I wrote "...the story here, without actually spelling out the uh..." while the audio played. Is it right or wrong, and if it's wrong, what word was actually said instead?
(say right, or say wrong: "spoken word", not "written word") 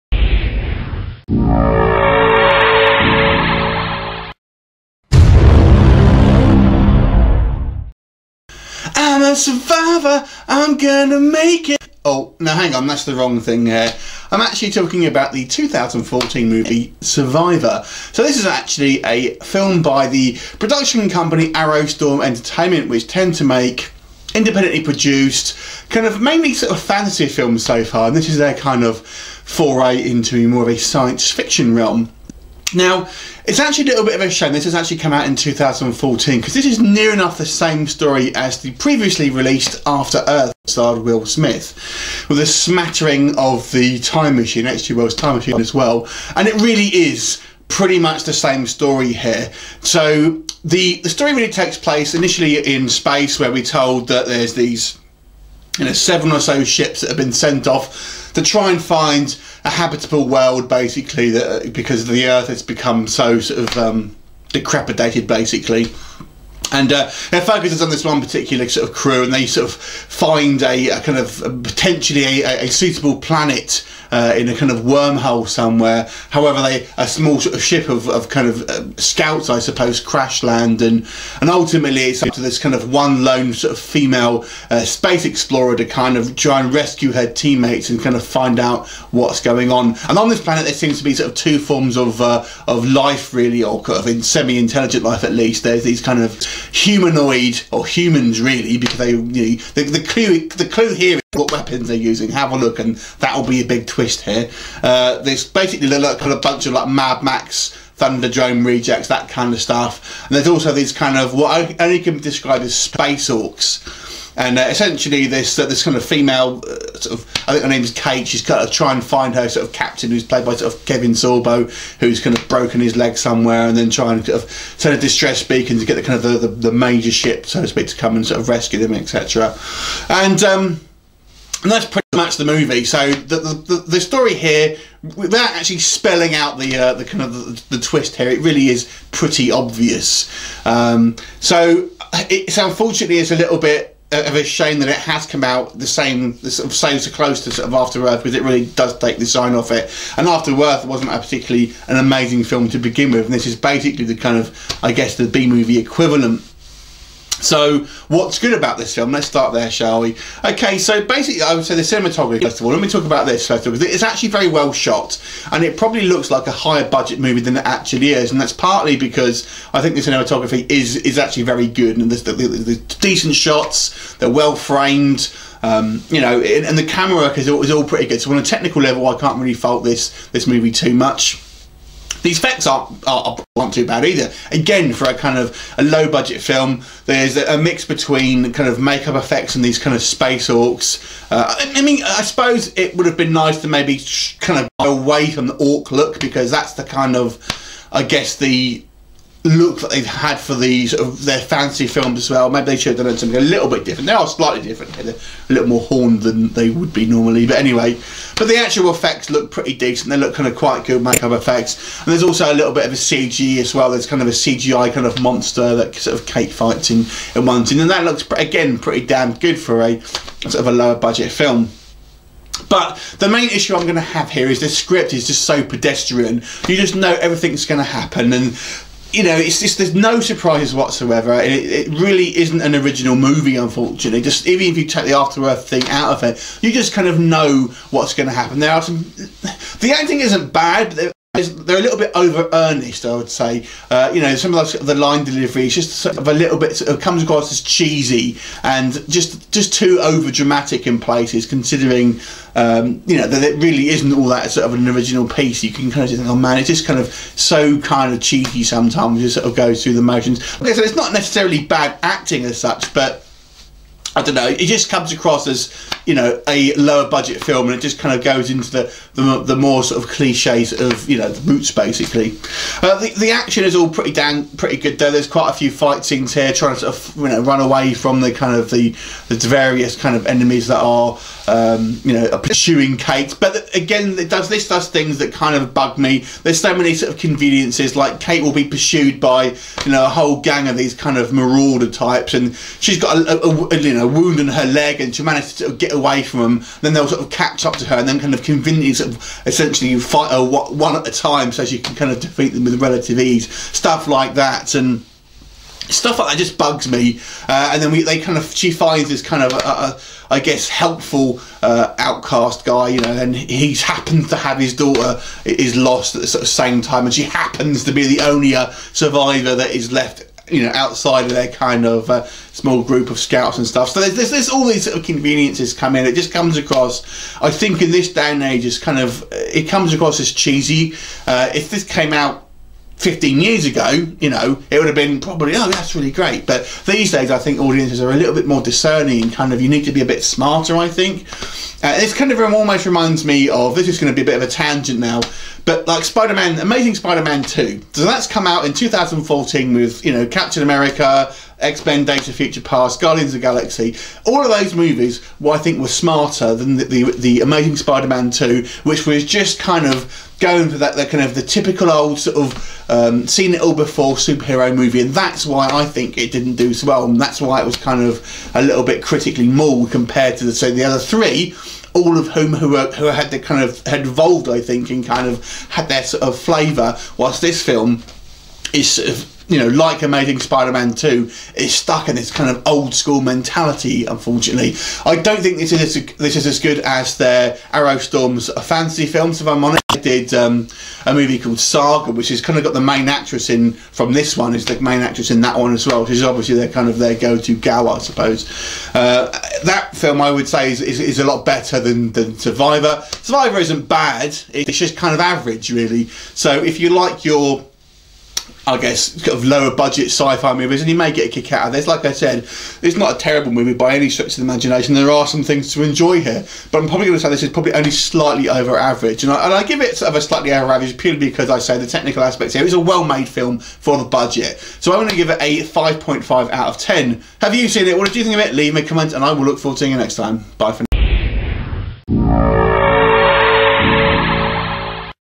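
right.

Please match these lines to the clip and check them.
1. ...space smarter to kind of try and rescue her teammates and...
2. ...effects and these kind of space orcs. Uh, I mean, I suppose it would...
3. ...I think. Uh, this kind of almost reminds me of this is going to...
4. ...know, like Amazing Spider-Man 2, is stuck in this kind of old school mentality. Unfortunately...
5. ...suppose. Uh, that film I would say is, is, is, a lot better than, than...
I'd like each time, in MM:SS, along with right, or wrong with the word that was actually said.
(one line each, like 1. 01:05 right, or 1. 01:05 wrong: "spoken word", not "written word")
1. 01:24 wrong: "explorer", not "smarter"
2. 03:09 right
3. 05:40 right
4. 06:19 right
5. 06:37 right.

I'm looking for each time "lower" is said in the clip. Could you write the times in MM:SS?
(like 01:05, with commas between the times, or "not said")
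03:40, 04:26, 06:49.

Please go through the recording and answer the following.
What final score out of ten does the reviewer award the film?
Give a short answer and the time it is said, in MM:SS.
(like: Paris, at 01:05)
5.5, at 07:05.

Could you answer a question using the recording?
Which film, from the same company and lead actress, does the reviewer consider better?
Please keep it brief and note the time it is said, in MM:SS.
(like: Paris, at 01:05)
Saga, at 06:31.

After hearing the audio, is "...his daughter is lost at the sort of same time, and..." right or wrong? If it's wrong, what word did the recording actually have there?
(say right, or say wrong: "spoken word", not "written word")
right.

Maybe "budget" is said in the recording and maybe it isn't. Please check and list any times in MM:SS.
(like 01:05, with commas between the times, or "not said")
02:46, 03:06, 03:40, 04:27, 06:49, 07:04.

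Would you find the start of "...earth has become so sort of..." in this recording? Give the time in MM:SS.
01:02.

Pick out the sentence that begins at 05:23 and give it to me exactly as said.
So there's, there's, there's, all these sort of conveniences come in.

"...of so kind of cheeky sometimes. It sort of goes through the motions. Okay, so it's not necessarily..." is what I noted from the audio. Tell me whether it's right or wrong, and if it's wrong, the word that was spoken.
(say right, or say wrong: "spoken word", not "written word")
right.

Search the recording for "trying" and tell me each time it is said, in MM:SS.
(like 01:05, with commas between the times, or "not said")
01:58, 02:03, 04:36.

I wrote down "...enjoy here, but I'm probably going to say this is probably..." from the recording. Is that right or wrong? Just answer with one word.
right.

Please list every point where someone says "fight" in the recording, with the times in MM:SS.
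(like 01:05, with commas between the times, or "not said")
03:36, 04:35, 04:59.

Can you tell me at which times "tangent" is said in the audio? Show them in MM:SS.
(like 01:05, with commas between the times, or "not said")
05:44.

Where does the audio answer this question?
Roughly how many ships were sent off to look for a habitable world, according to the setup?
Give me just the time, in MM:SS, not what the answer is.
00:55.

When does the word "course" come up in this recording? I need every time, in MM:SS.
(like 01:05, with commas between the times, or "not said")
not said.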